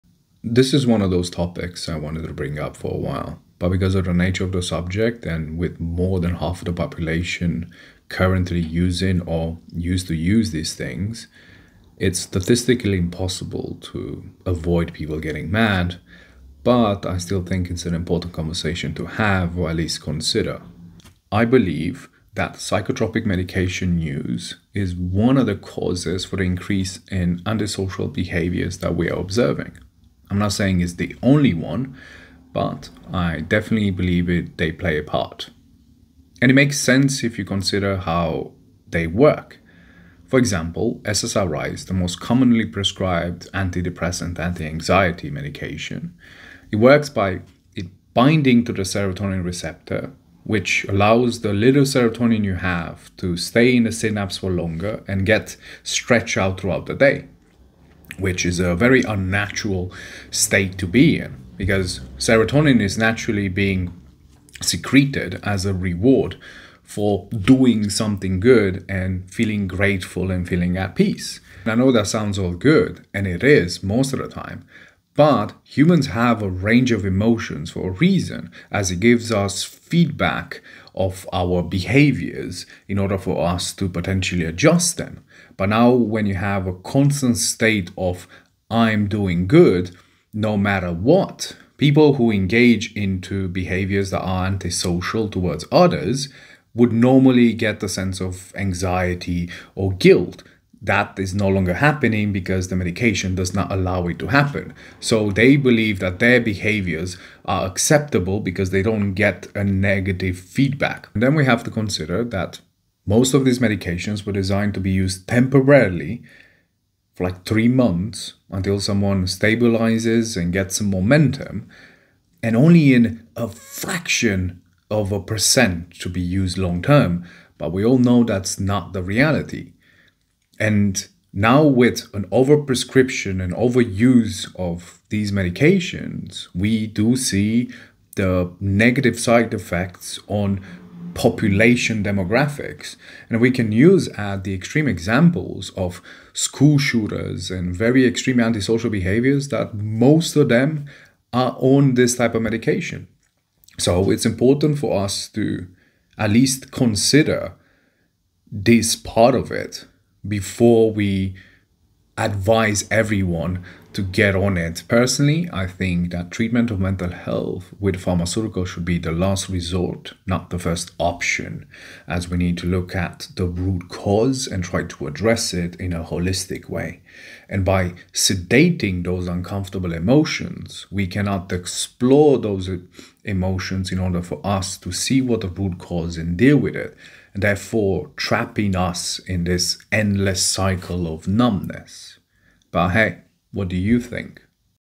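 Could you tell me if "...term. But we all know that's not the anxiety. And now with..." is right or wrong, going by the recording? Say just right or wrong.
wrong.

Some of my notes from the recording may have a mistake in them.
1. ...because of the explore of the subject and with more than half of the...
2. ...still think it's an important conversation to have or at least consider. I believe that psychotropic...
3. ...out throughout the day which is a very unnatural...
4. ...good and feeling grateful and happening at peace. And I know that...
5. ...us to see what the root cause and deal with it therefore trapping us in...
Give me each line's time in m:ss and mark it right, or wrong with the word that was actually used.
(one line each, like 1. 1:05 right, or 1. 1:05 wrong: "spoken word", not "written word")
1. 0:03 wrong: "nature", not "explore"
2. 0:17 right
3. 0:56 right
4. 1:08 wrong: "feeling", not "happening"
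5. 3:04 right.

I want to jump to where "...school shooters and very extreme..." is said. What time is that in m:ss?
2:26.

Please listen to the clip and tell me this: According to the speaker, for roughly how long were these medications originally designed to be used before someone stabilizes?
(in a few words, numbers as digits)
3 months.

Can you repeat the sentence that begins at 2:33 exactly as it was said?
So it's important for us to at least consider this part of it before we advise everyone to get on it.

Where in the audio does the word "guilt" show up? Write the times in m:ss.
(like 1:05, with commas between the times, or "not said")
1:39.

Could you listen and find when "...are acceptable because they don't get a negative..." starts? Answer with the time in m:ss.
1:47.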